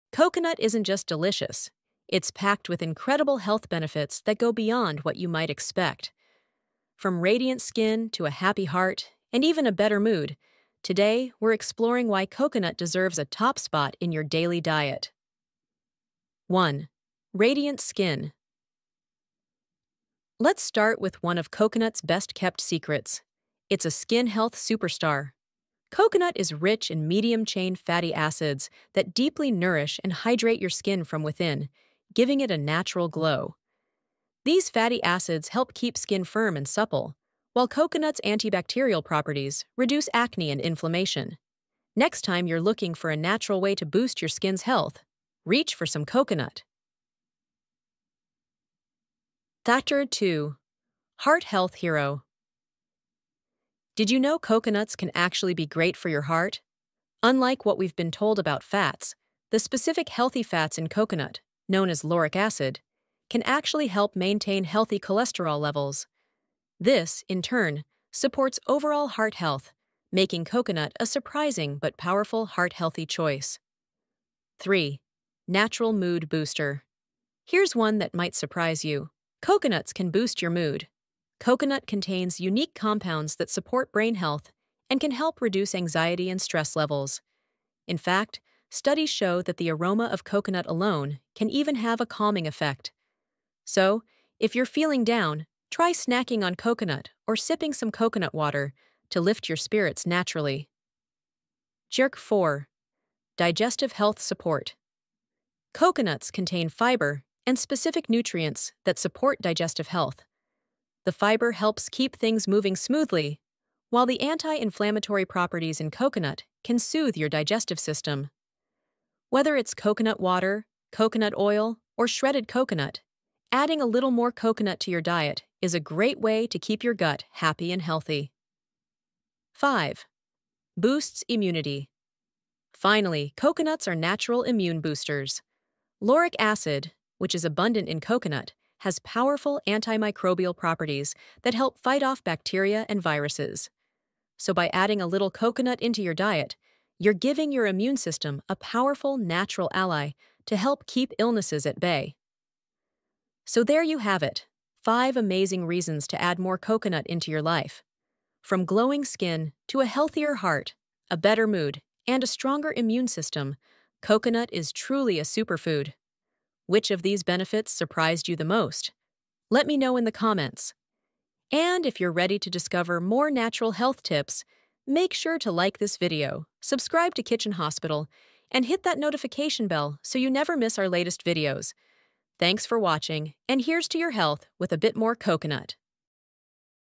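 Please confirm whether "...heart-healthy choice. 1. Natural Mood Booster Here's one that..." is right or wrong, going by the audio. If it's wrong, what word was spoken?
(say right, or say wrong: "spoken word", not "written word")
wrong: "3", not "1".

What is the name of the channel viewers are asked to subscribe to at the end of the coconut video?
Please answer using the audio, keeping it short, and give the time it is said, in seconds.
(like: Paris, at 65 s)
Kitchen Hospital, at 177 s.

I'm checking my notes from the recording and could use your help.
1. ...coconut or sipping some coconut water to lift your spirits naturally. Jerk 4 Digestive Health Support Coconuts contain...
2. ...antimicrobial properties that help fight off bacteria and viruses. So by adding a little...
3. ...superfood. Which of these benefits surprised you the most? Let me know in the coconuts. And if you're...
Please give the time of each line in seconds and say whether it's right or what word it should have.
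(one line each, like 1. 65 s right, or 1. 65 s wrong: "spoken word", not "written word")
1. 96 s right
2. 139 s right
3. 165 s wrong: "comments", not "coconuts".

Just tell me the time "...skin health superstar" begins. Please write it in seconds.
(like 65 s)
23 s.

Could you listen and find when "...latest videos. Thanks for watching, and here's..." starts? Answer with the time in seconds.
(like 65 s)
180 s.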